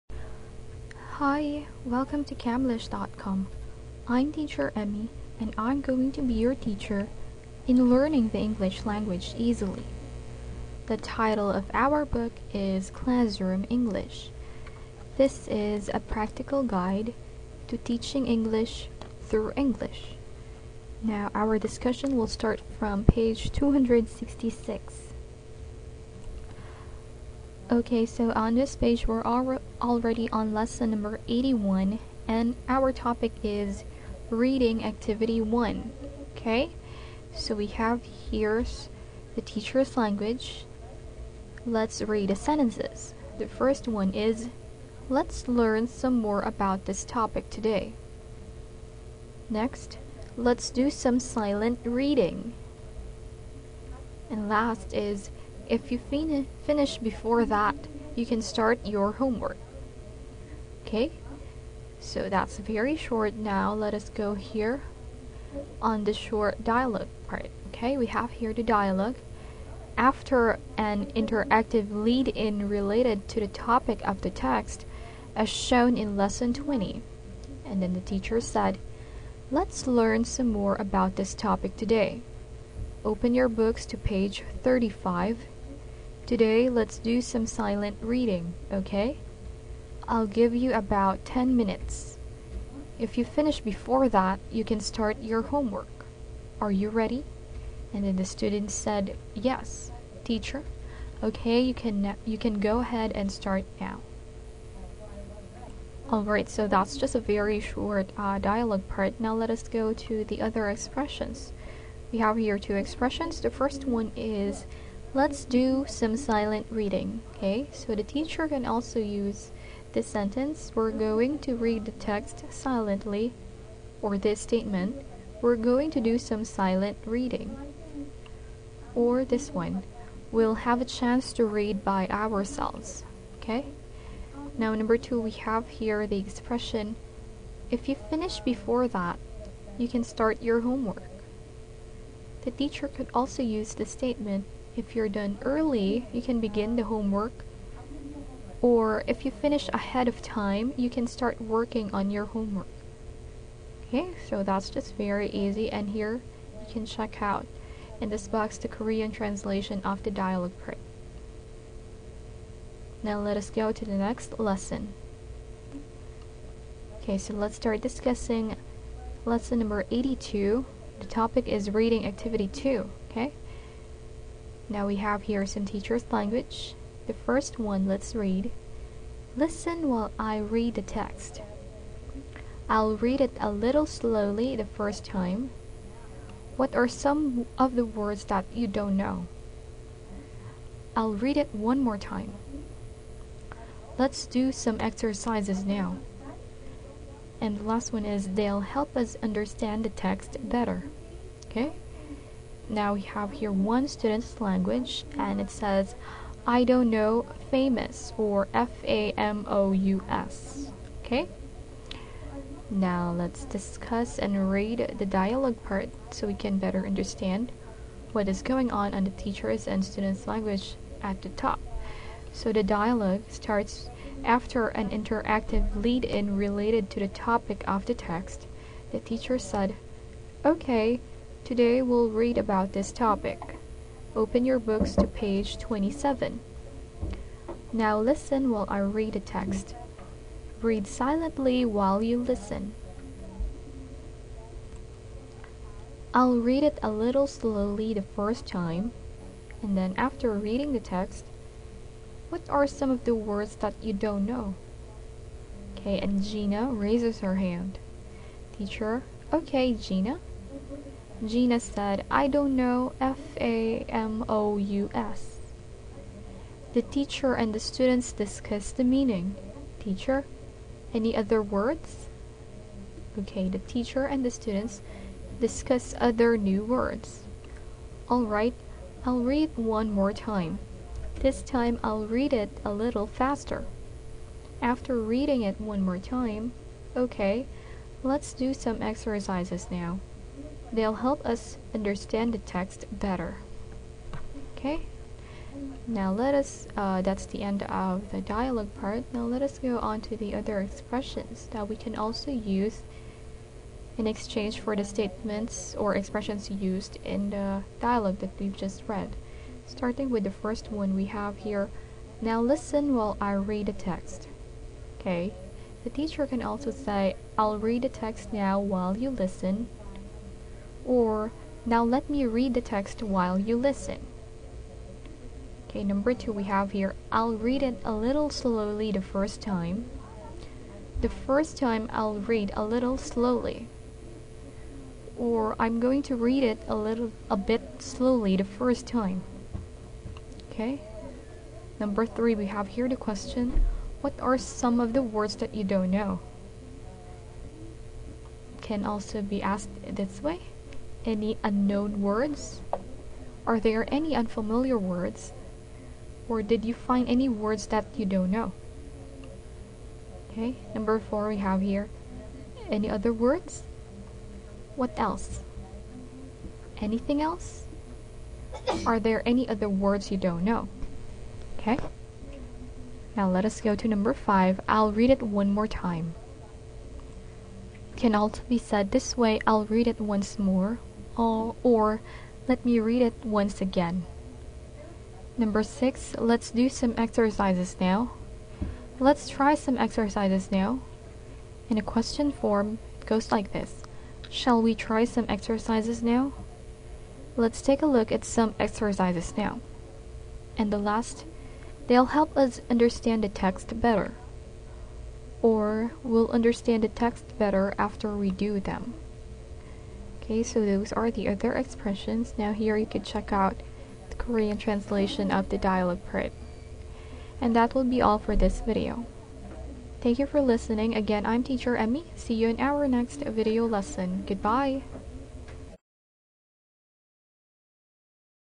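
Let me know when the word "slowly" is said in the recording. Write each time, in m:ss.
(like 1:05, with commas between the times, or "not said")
3:03, 4:07, 5:28, 5:32, 5:37.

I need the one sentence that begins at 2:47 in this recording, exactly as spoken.
Okay, so let's start discussing lesson number 82.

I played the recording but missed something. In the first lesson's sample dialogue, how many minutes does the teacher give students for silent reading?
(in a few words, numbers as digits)
10.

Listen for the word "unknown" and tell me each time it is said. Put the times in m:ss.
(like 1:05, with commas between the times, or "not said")
5:51.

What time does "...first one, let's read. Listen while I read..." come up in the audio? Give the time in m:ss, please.
2:57.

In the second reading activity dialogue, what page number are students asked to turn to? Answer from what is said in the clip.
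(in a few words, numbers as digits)
27.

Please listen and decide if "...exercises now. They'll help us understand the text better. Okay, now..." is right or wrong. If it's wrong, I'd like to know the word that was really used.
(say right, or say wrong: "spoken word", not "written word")
right.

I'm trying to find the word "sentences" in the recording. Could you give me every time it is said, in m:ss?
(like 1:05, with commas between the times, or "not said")
0:42, 2:00.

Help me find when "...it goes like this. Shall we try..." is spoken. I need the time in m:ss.
6:32.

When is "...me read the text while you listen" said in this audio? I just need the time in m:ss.
5:22.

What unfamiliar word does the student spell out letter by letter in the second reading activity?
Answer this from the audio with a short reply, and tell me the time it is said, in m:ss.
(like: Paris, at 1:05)
famous, at 3:27.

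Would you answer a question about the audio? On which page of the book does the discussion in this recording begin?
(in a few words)
266.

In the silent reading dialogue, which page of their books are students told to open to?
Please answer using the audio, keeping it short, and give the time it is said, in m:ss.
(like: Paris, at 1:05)
35, at 1:23.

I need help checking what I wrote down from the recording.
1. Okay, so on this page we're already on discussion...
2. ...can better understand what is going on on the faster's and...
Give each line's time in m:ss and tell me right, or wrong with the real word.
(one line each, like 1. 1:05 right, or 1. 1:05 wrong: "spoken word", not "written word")
1. 0:27 wrong: "lesson", not "discussion"
2. 3:36 wrong: "teacher", not "faster".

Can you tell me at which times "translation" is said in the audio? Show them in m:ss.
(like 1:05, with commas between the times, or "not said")
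2:39, 6:54.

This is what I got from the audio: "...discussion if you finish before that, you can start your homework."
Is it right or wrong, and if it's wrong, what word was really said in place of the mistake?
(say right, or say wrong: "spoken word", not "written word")
wrong: "expression", not "discussion".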